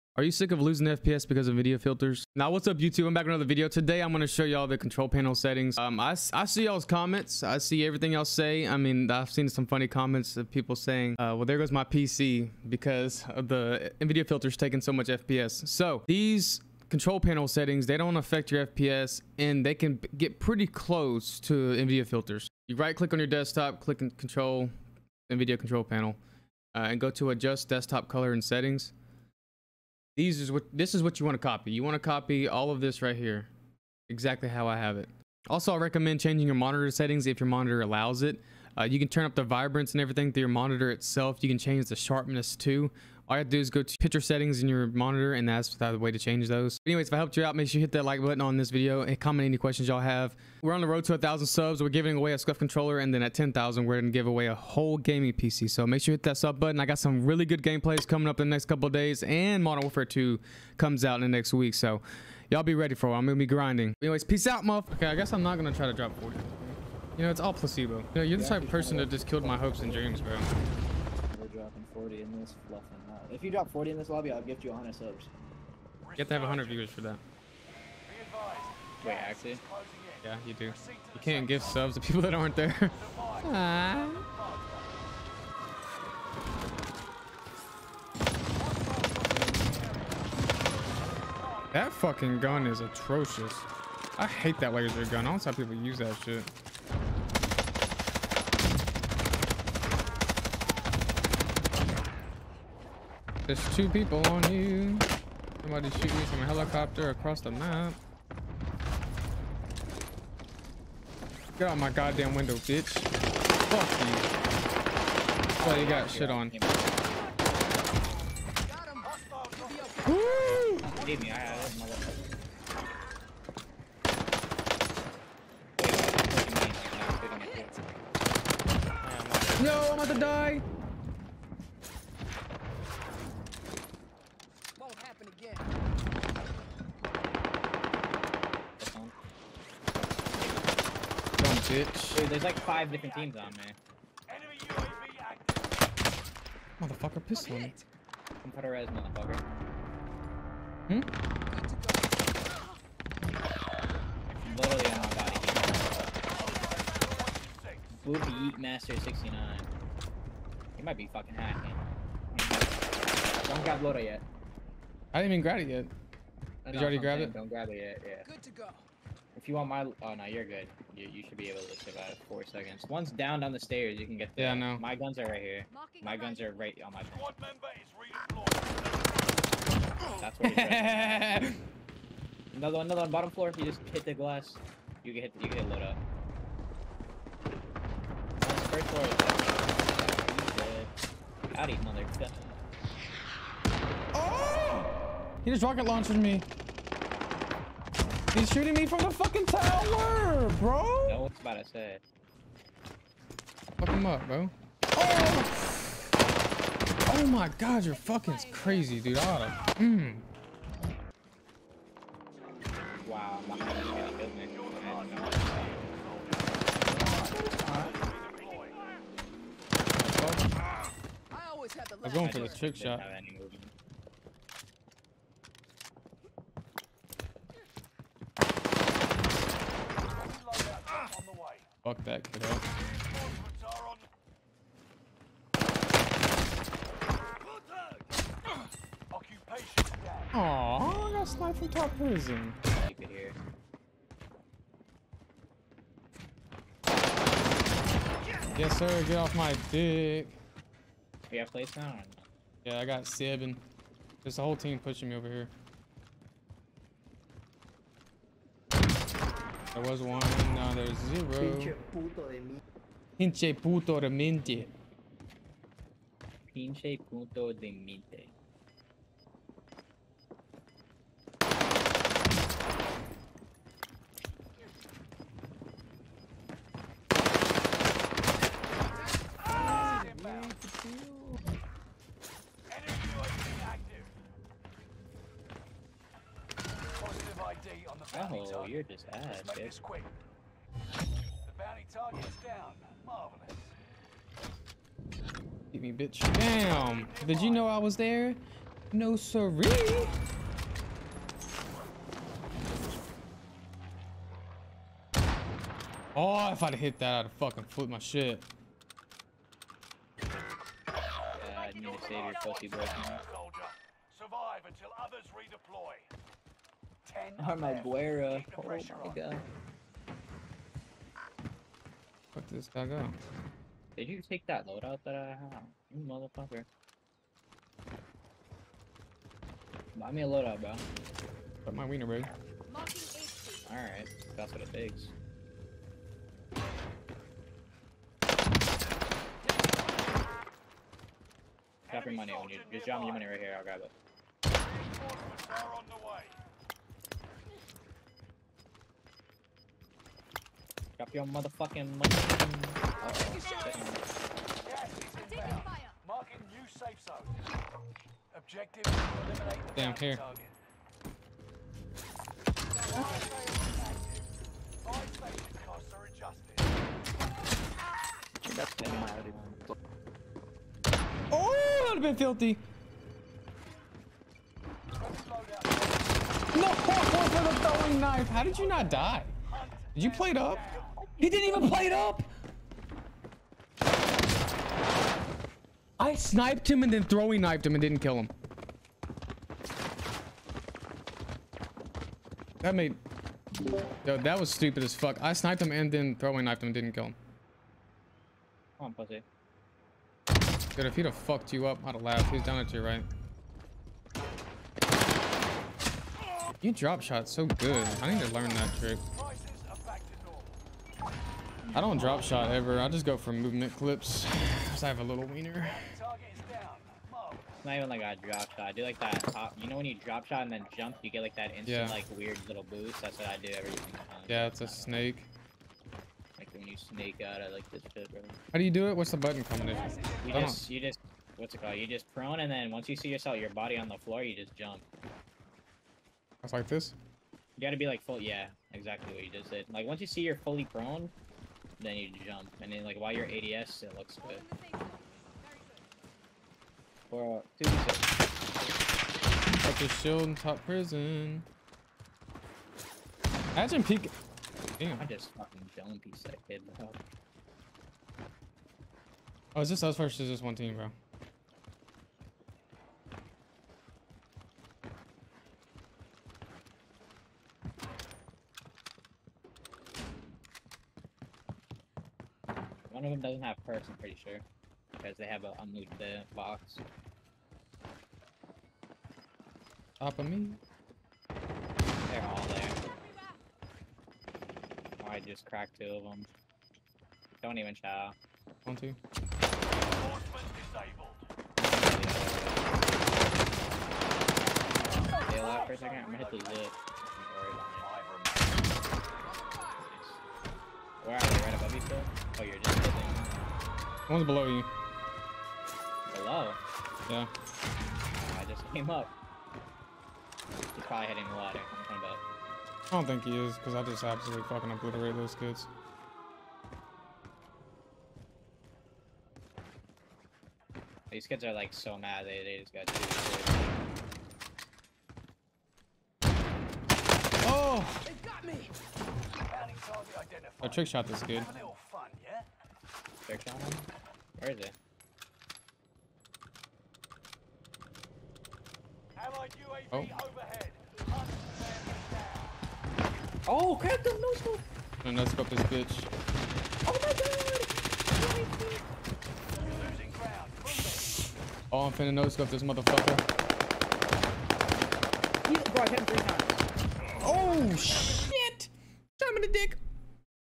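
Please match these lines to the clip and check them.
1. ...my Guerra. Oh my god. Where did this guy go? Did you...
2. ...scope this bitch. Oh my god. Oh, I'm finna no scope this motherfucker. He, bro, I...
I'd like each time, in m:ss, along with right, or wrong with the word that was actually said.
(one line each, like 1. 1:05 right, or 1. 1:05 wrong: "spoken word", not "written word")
1. 5:17 right
2. 9:05 right.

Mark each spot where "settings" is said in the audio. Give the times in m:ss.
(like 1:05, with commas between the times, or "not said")
0:05, 0:17, 0:28, 0:36, 0:44.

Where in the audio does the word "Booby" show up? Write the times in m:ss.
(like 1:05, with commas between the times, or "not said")
2:38.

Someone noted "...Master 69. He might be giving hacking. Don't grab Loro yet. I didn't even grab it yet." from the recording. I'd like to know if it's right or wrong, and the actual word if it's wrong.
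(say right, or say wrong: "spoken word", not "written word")
wrong: "fucking", not "giving".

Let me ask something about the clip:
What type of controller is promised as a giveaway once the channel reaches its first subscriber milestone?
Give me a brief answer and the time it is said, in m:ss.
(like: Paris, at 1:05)
SCUF controller, at 0:52.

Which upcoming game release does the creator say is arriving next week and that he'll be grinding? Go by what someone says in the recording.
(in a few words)
Modern Warfare 2.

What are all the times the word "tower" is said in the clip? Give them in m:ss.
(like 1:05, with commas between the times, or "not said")
3:19.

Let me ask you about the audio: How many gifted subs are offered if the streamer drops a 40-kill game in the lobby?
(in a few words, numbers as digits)
100.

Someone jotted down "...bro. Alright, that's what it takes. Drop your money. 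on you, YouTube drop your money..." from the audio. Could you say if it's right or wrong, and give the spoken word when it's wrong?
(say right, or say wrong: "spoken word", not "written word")
wrong: "Just", not "YouTube".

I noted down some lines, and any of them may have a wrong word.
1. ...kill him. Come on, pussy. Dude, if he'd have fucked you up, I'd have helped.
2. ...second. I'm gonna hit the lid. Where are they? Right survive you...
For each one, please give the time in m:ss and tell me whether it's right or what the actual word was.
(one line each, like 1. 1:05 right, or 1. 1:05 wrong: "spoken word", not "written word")
1. 6:36 wrong: "laughed", not "helped"
2. 8:15 wrong: "above", not "survive".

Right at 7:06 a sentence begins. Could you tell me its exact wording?
Like when you snake out, I like this shit, bro.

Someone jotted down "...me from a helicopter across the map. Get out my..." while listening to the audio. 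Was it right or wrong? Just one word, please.
right.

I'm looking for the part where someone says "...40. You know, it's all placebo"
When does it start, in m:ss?
1:06.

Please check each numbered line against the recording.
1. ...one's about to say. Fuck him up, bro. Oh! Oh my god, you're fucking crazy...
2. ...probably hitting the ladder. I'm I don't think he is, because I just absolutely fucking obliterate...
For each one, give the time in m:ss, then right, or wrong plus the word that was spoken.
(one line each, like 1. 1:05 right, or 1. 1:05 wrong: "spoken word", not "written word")
1. 3:21 right
2. 8:30 right.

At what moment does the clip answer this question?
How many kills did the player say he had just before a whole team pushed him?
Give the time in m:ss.
4:13.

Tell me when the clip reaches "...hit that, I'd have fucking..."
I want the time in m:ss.
5:06.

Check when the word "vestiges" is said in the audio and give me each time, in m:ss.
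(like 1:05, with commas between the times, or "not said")
not said.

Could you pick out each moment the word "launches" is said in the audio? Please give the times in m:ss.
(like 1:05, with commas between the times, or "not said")
3:15.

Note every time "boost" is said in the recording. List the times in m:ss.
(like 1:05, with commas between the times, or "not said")
7:02.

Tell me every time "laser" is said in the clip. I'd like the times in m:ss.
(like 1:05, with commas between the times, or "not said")
1:34.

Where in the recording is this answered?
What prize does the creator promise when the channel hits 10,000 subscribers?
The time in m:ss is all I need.
0:54.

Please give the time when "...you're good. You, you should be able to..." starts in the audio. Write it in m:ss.
2:50.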